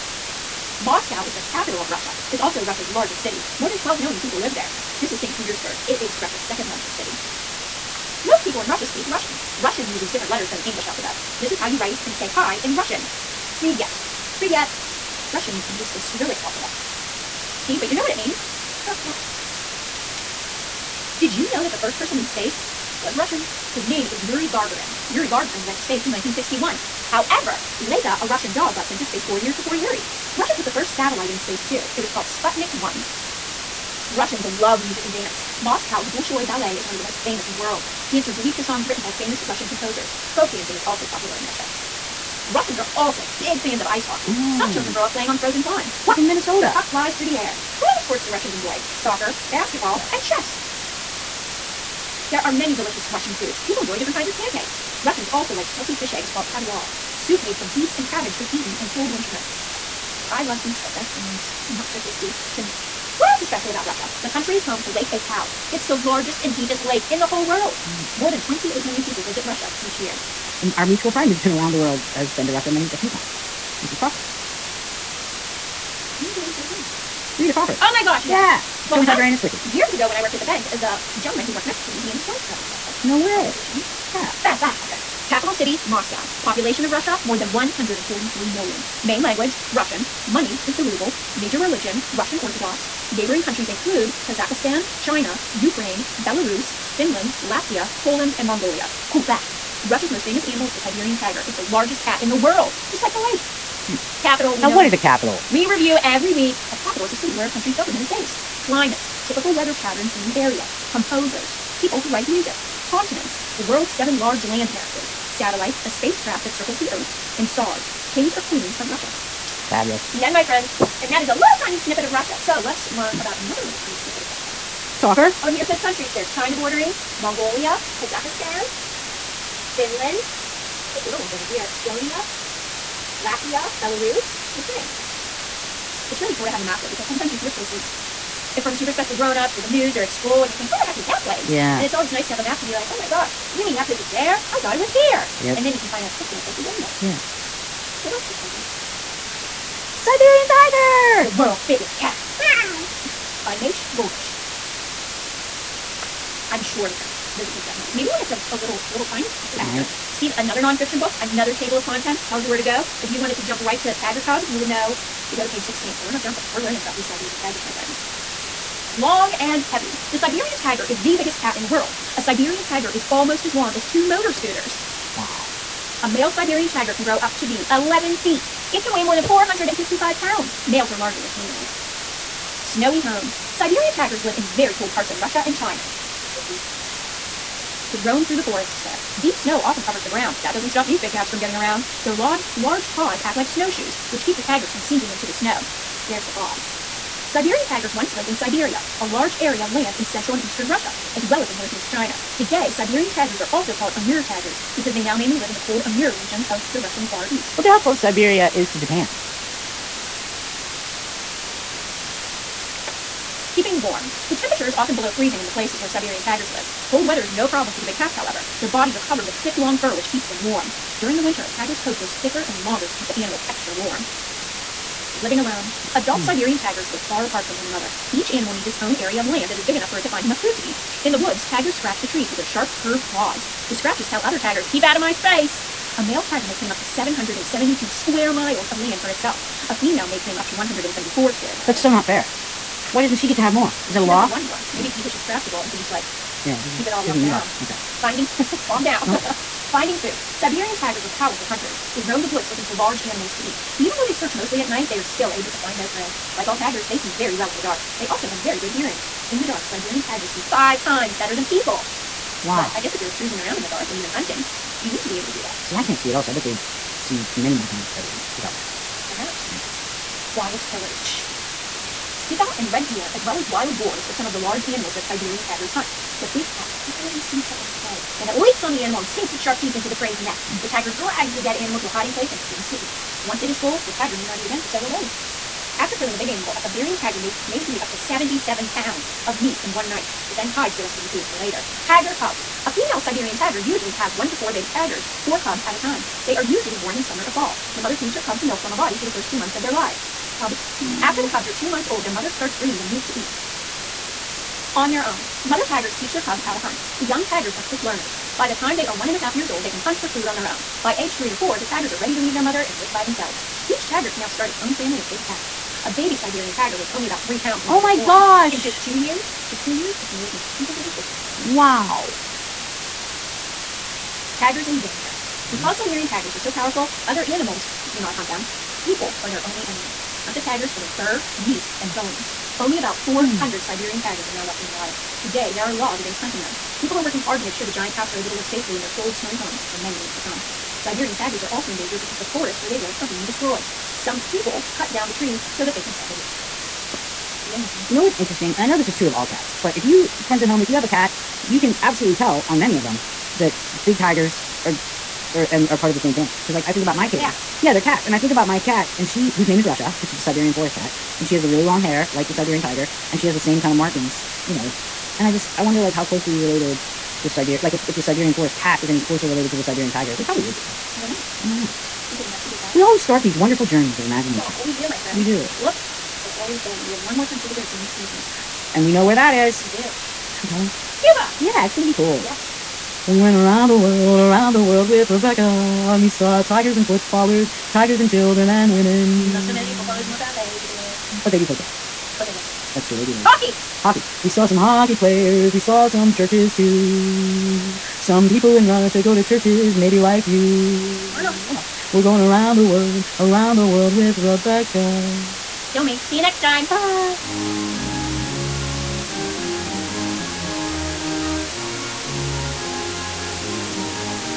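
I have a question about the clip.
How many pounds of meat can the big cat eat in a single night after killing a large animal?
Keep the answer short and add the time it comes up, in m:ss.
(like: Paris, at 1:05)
77 pounds, at 4:47.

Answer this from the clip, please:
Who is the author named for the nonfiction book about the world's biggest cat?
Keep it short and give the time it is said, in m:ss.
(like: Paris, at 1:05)
Meish Goldish, at 2:33.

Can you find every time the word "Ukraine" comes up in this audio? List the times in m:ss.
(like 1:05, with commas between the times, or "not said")
1:35, 2:14.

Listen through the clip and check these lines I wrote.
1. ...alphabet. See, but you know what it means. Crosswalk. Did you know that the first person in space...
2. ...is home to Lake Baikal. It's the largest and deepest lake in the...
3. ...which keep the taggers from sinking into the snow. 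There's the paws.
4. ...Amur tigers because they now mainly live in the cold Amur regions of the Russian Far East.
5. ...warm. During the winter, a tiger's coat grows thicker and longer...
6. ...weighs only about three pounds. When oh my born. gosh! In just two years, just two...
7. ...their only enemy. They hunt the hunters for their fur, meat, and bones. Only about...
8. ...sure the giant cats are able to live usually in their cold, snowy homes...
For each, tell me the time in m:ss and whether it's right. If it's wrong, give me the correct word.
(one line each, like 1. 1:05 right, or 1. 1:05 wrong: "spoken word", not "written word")
1. 0:16 right
2. 1:04 right
3. 3:14 right
4. 3:23 right
5. 3:40 right
6. 5:16 right
7. 5:29 wrong: "taggers", not "hunters"
8. 5:37 wrong: "safely", not "usually".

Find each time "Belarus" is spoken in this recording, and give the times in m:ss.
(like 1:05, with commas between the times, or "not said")
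1:36, 2:13.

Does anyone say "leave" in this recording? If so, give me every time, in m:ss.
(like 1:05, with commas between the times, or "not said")
5:12.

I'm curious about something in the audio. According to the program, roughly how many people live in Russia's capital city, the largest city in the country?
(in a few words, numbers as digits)
More than 12 million.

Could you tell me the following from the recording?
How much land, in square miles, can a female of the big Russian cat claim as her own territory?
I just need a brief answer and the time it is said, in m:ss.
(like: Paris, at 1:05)
174 square miles, at 4:00.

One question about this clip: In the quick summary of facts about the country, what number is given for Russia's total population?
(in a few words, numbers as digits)
More than 143 million.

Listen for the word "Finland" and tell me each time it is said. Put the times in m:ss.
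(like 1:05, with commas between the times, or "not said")
1:36, 2:09.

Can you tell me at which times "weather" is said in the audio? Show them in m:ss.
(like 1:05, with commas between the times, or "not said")
1:49, 3:37.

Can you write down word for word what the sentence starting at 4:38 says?
Then it leaps on the animal and sinks its sharp teeth into the prey's neck.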